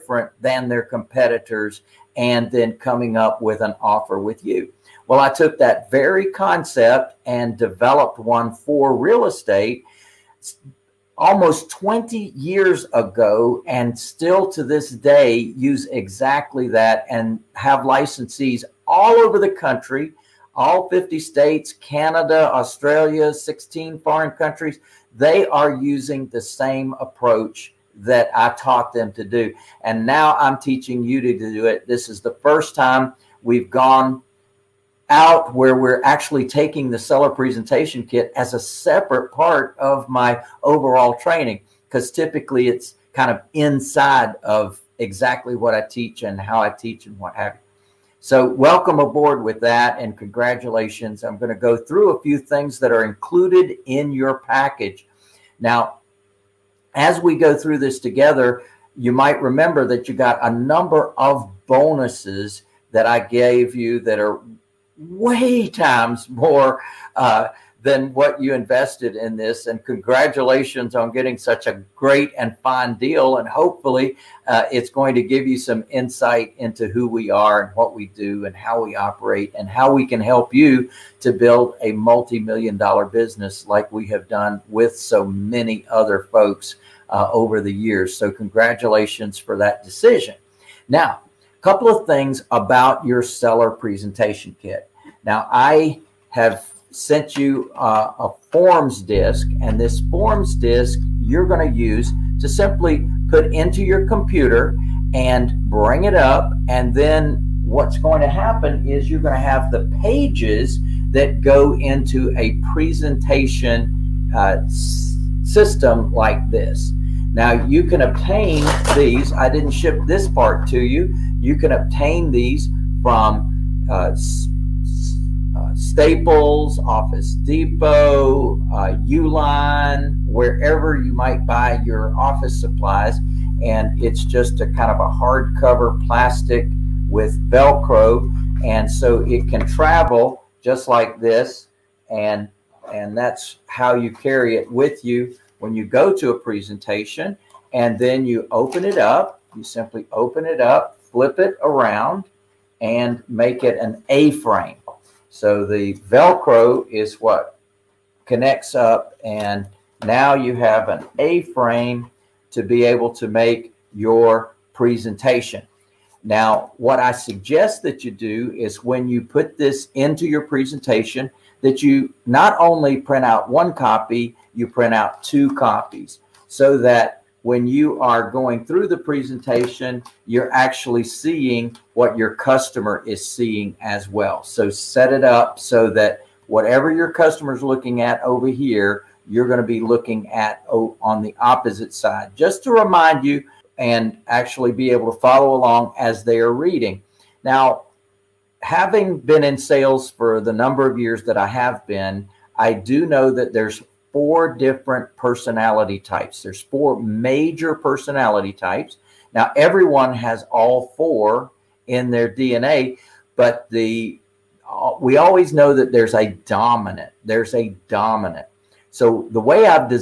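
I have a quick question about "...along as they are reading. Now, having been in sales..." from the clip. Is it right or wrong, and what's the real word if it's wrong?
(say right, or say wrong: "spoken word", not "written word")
right.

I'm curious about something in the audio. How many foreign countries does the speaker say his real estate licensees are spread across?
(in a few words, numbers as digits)
16.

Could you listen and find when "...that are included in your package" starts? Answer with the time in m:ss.
0:52.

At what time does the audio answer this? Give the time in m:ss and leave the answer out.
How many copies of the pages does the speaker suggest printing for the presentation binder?
2:55.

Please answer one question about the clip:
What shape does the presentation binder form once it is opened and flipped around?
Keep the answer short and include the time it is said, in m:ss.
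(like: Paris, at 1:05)
A-frame, at 2:41.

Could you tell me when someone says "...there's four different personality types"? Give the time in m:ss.
3:23.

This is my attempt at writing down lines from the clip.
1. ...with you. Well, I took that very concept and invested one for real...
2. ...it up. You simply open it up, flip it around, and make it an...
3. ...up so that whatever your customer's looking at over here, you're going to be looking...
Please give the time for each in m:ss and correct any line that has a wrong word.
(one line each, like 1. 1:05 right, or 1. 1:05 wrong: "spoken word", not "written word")
1. 0:04 wrong: "developed", not "invested"
2. 2:28 right
3. 3:05 right.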